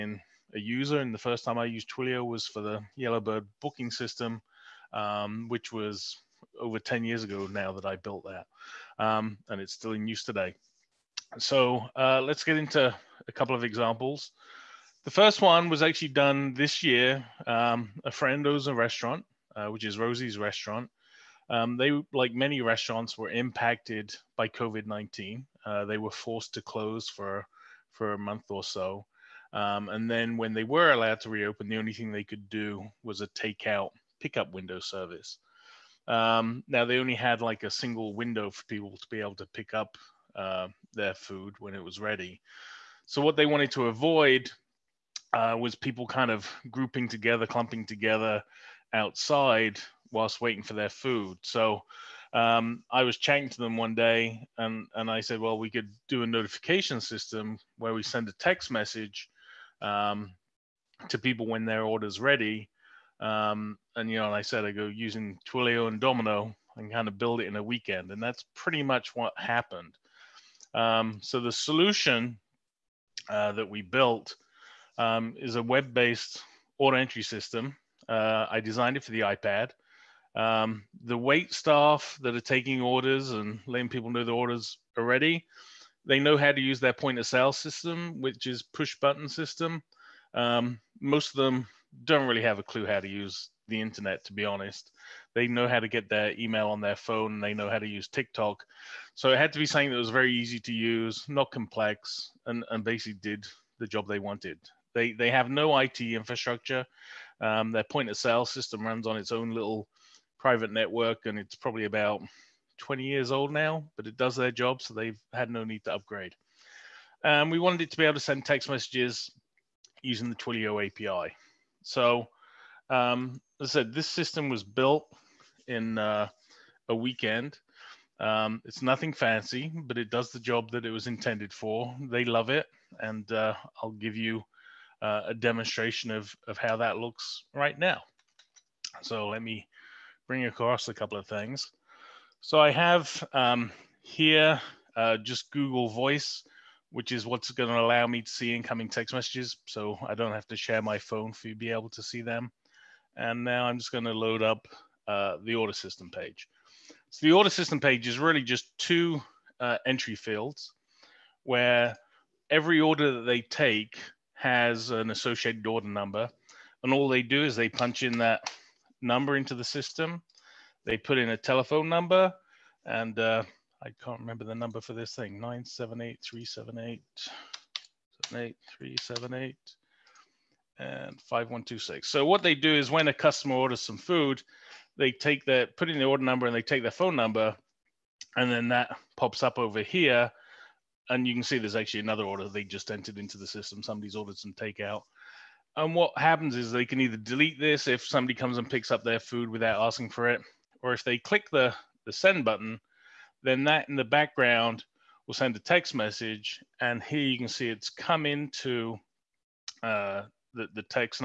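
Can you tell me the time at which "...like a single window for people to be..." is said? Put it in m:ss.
0:37.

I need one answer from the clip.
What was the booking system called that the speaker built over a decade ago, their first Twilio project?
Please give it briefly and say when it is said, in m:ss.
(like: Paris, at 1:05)
Yellowbird, at 0:02.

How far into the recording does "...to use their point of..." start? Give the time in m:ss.
1:26.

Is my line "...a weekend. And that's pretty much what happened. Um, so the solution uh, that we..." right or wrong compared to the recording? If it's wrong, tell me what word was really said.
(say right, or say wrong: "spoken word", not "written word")
right.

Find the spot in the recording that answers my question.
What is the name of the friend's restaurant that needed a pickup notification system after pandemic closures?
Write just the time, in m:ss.
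0:19.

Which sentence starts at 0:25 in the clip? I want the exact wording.
Uh, they were forced to close for, for a month or so.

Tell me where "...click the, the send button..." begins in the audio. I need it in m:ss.
3:21.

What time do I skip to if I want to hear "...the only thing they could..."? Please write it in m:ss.
0:31.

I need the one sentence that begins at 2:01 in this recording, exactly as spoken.
So um, as I said, this system was built in uh, a weekend.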